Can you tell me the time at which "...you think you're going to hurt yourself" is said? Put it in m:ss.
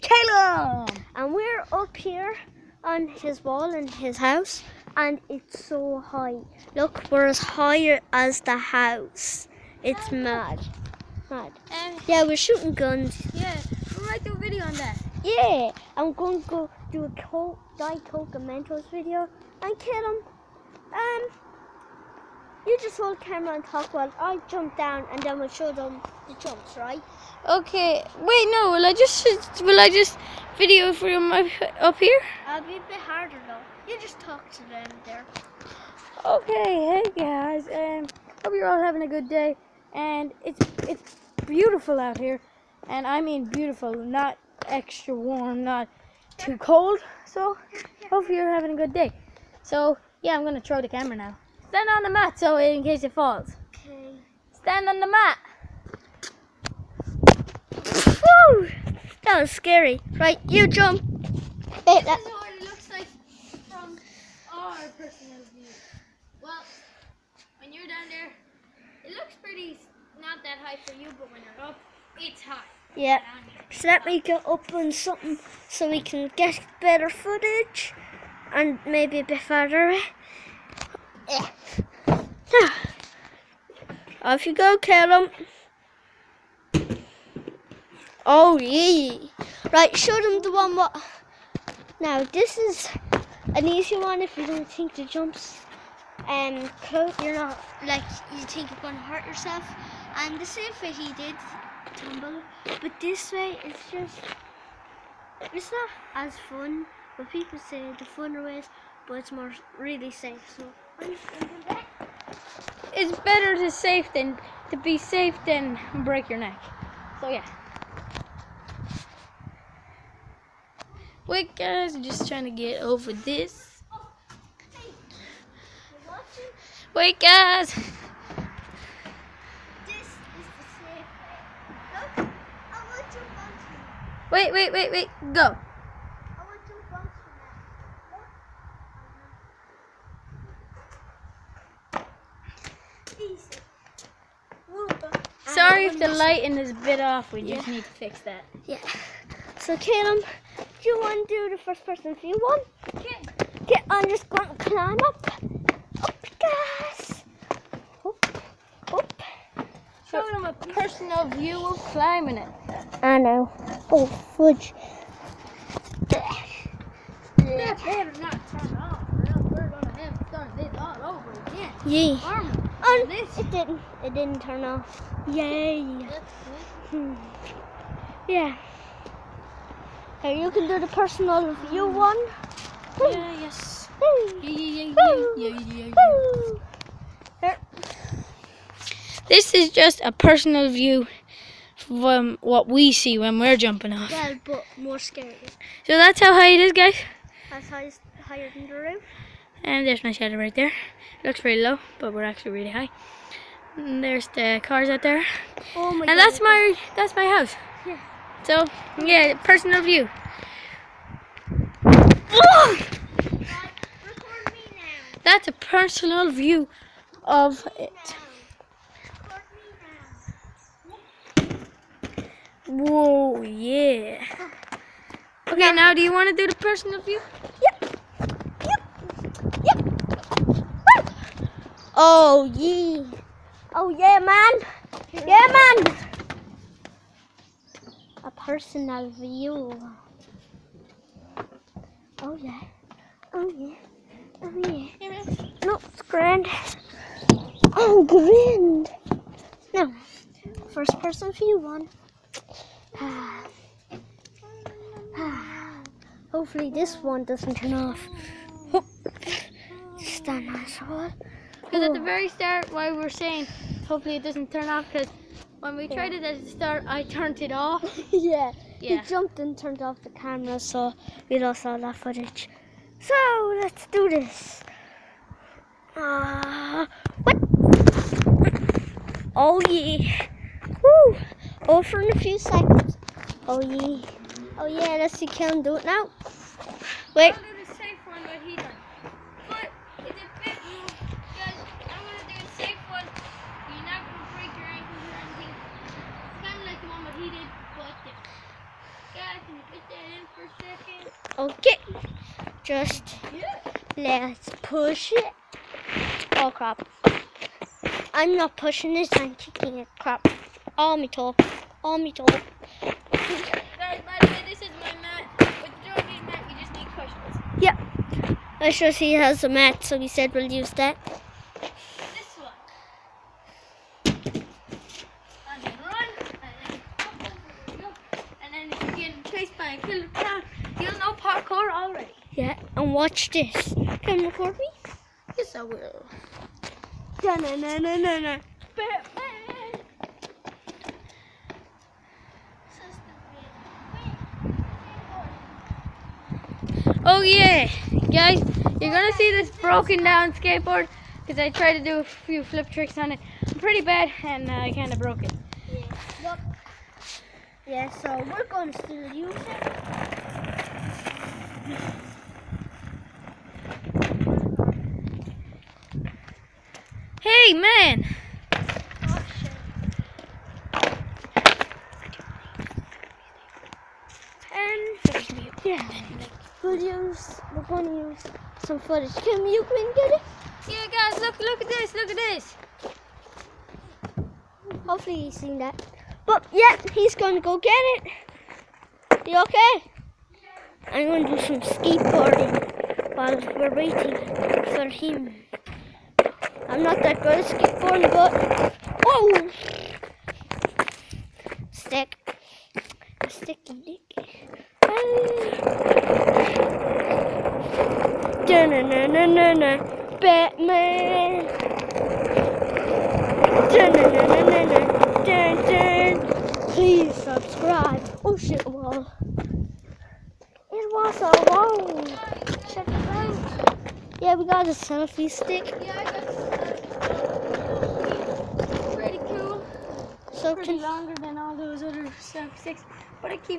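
1:38.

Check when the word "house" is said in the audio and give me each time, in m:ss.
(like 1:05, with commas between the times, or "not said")
0:04, 0:08, 3:27.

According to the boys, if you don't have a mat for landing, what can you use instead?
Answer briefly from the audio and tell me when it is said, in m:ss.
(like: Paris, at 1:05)
Cushions, at 5:16.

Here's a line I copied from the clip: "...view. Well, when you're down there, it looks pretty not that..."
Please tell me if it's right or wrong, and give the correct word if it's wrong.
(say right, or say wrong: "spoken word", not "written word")
right.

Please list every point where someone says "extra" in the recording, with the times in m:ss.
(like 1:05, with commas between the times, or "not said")
0:44.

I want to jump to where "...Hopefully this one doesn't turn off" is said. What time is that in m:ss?
4:16.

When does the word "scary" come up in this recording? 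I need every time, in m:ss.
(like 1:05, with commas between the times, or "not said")
0:59, 3:14.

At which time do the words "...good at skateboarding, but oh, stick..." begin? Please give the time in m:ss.
6:37.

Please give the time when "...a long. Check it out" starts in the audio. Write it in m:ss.
7:01.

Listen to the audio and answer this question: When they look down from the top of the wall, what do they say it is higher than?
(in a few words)
The roof.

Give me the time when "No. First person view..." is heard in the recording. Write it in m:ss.
4:09.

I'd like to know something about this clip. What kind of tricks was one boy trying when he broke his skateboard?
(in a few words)
Flip tricks.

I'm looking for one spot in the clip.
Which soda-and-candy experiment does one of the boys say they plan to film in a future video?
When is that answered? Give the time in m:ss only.
0:17.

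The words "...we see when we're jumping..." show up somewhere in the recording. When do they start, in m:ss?
3:12.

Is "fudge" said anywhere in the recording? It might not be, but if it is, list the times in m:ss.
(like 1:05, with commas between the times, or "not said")
2:44.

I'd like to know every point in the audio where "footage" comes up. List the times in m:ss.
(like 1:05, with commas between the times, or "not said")
1:17, 4:31, 6:18.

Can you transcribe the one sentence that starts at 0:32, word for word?
I'll be a bit harder though.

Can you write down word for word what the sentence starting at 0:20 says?
Um, you just hold camera and talk while I jump down and then we'll show them the jumps, right?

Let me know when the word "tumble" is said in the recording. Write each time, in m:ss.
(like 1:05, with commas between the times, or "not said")
1:41.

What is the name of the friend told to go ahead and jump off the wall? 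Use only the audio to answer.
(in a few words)
Callum.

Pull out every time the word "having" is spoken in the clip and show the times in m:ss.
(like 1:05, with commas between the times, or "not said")
0:38, 0:48.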